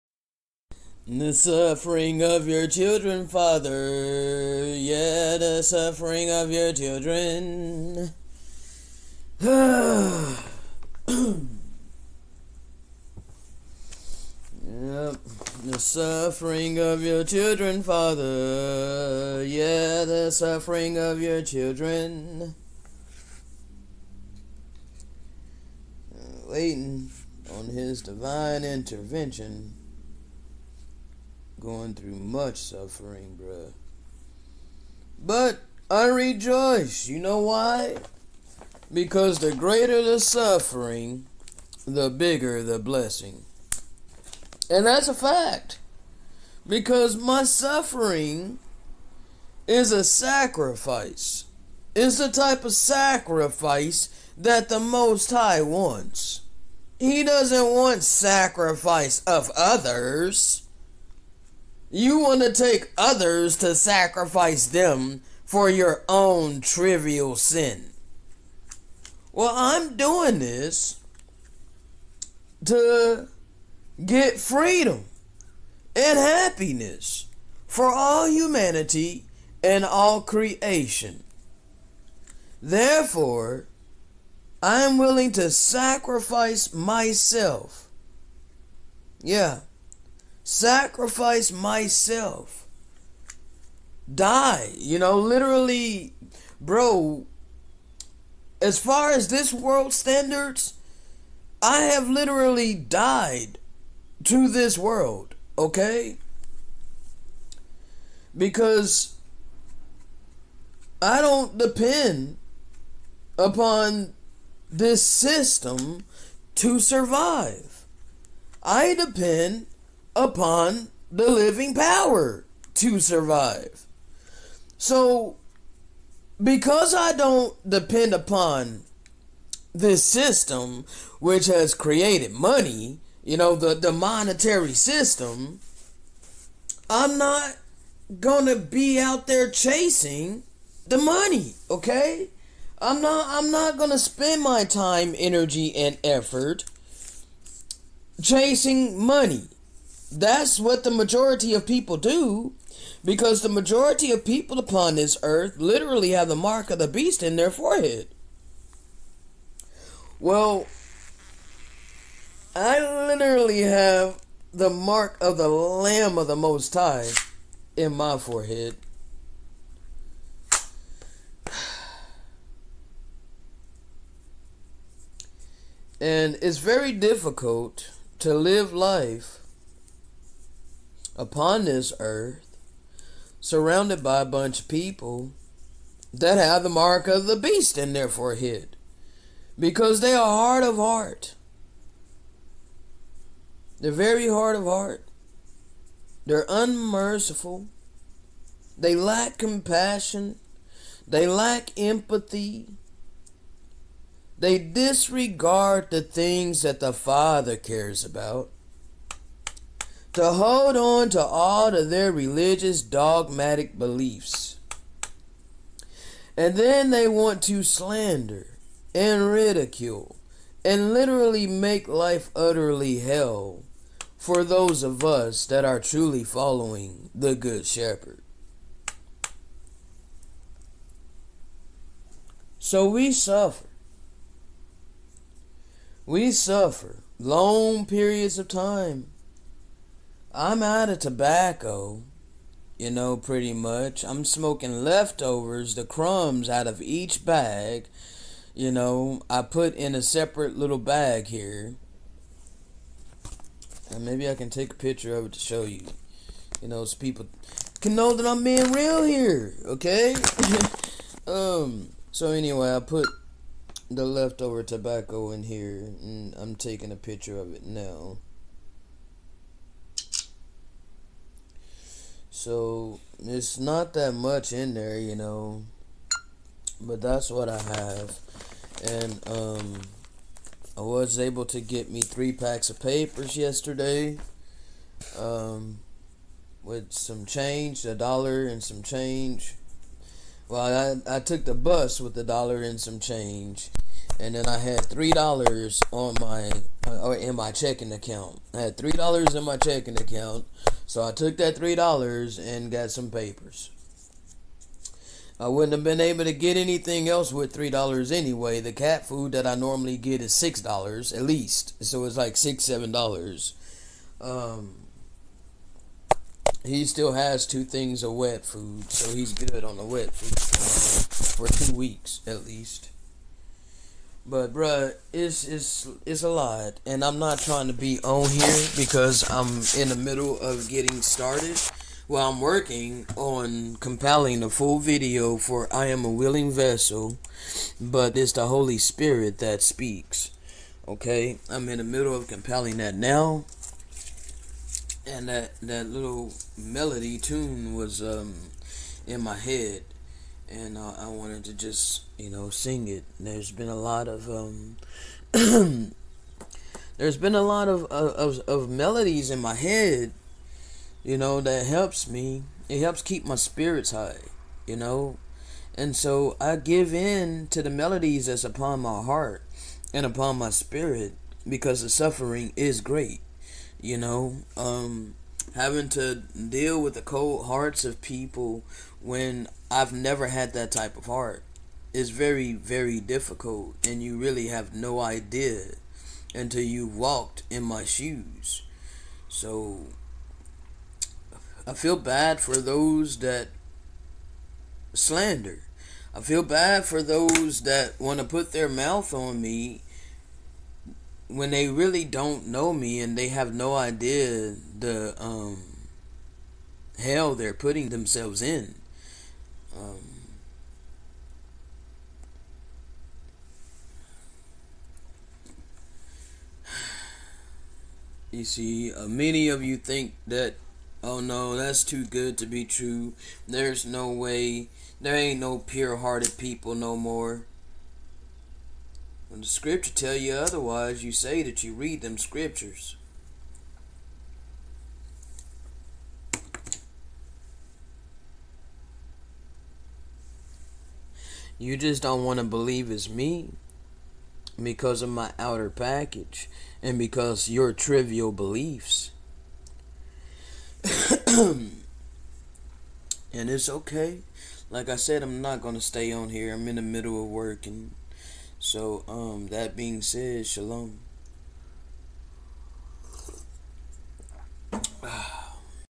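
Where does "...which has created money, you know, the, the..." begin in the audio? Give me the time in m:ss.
2:11.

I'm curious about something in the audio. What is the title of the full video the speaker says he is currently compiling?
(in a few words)
I am a willing vessel.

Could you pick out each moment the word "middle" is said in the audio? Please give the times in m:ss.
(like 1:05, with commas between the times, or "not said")
5:29, 5:41, 7:36.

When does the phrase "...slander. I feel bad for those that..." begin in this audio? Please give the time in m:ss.
6:34.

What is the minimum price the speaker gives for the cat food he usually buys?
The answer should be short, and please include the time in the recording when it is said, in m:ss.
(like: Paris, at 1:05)
$6, at 5:10.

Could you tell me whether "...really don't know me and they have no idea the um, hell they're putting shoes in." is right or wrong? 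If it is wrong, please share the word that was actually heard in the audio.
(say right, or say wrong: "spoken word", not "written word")
wrong: "themselves", not "shoes".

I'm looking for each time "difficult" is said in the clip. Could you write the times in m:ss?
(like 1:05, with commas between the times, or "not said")
2:56, 6:23.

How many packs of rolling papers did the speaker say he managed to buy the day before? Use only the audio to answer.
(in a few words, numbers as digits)
3.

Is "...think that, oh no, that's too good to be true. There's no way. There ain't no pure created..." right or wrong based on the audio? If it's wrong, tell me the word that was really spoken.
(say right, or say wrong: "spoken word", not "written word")
wrong: "hearted", not "created".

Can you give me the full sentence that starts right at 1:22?
Therefore, I am willing to sacrifice myself.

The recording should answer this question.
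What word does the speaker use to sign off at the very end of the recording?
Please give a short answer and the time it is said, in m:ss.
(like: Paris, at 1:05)
shalom, at 7:40.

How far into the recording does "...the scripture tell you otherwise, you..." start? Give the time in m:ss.
7:09.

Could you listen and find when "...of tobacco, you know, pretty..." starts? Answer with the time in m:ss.
4:00.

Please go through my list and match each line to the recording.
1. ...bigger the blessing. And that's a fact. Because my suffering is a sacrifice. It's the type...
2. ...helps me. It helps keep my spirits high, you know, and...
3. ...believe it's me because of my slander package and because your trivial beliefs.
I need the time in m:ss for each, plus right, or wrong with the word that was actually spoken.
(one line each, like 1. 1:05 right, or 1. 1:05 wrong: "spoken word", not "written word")
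1. 0:42 right
2. 6:01 right
3. 7:22 wrong: "outer", not "slander".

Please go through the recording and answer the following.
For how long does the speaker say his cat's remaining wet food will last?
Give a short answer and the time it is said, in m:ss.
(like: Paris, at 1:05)
2 weeks, at 5:21.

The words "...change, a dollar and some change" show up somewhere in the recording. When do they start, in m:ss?
4:47.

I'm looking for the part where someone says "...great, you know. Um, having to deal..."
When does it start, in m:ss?
6:12.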